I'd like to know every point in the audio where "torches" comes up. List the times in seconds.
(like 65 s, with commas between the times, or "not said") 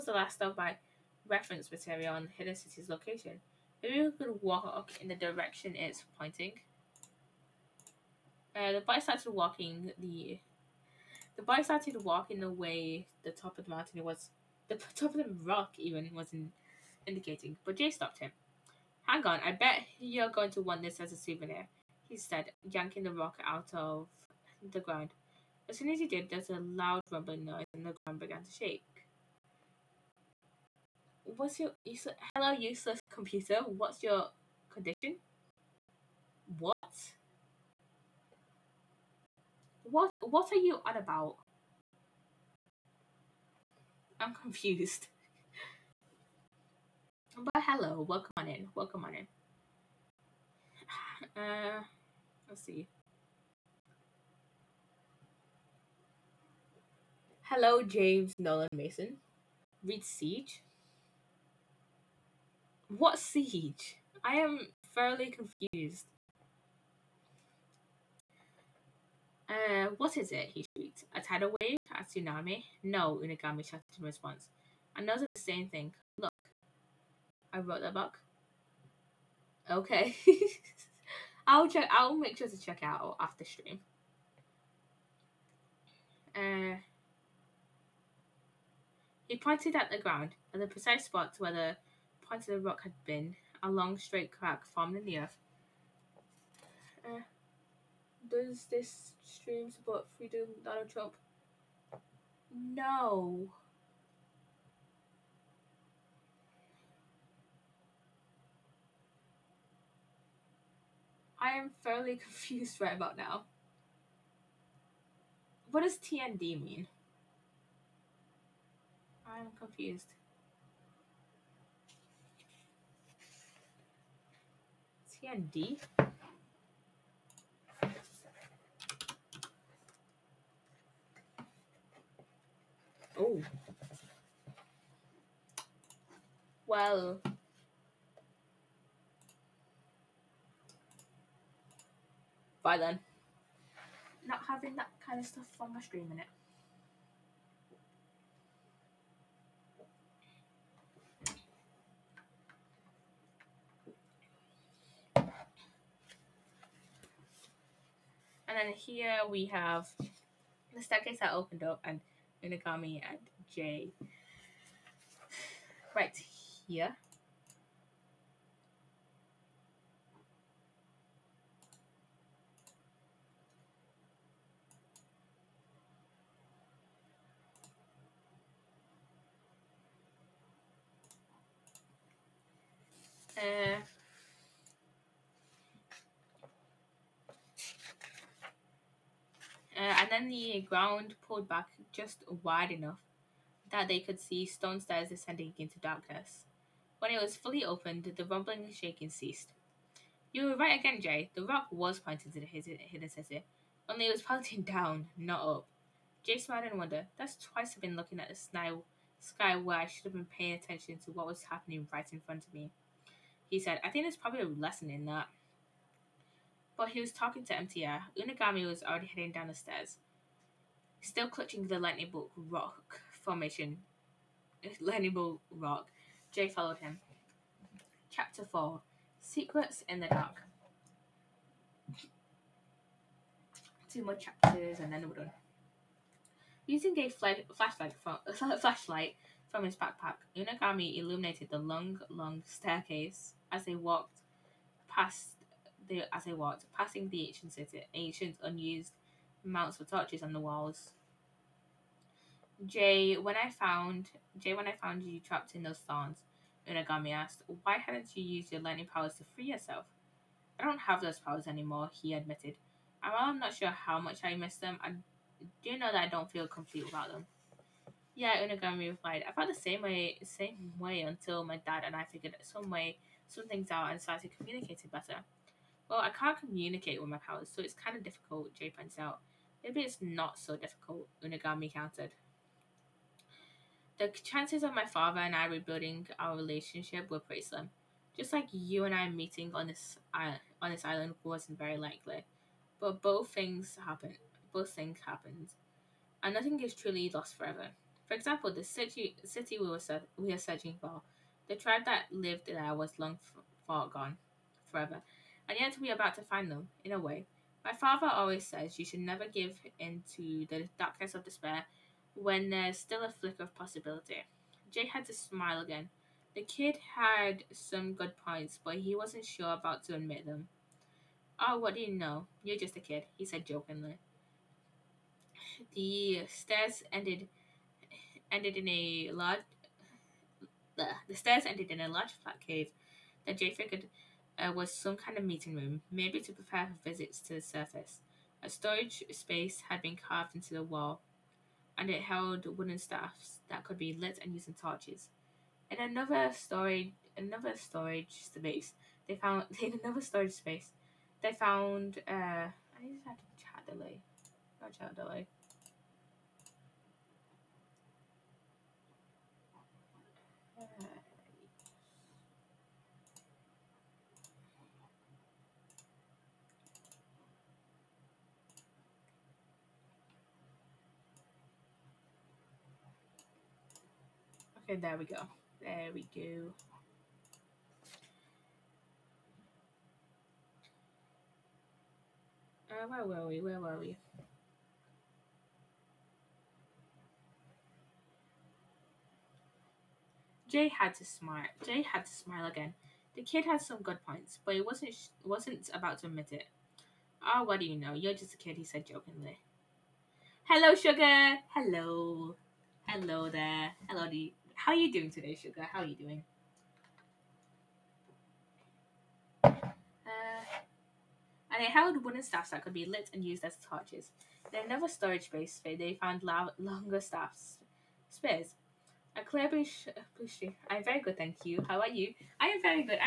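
249 s, 344 s, 413 s.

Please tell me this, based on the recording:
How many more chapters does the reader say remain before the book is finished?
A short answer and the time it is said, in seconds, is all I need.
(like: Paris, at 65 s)
2, at 233 s.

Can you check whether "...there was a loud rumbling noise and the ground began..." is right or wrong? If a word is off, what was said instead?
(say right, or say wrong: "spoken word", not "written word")
right.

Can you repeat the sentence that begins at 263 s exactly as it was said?
And while I'm not sure how much I miss them, I do know that I don't feel complete without them.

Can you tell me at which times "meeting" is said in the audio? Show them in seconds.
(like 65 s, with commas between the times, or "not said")
289 s, 335 s.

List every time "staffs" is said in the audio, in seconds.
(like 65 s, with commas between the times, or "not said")
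342 s, 412 s, 417 s.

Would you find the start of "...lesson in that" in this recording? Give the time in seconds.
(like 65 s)
214 s.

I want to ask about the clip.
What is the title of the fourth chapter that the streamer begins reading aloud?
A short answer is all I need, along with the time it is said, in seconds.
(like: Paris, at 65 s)
Secrets in the Dark, at 229 s.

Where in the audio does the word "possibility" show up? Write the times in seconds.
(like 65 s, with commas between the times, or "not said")
313 s.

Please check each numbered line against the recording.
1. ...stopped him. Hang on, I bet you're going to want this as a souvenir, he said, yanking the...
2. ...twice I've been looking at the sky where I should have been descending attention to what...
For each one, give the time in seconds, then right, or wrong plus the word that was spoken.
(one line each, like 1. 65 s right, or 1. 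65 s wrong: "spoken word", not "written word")
1. 17 s right
2. 207 s wrong: "paying", not "descending".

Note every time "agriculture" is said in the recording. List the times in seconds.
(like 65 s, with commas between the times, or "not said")
not said.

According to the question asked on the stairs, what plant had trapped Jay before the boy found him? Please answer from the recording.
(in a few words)
Thorns.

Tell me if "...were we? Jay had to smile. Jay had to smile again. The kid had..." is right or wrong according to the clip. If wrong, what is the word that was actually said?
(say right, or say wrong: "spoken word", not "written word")
right.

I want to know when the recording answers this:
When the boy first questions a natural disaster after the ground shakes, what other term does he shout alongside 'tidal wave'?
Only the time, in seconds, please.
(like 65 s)
71 s.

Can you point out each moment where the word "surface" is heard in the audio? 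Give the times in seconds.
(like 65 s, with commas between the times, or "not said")
337 s.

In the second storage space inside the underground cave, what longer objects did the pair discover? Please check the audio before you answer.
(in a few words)
Spears.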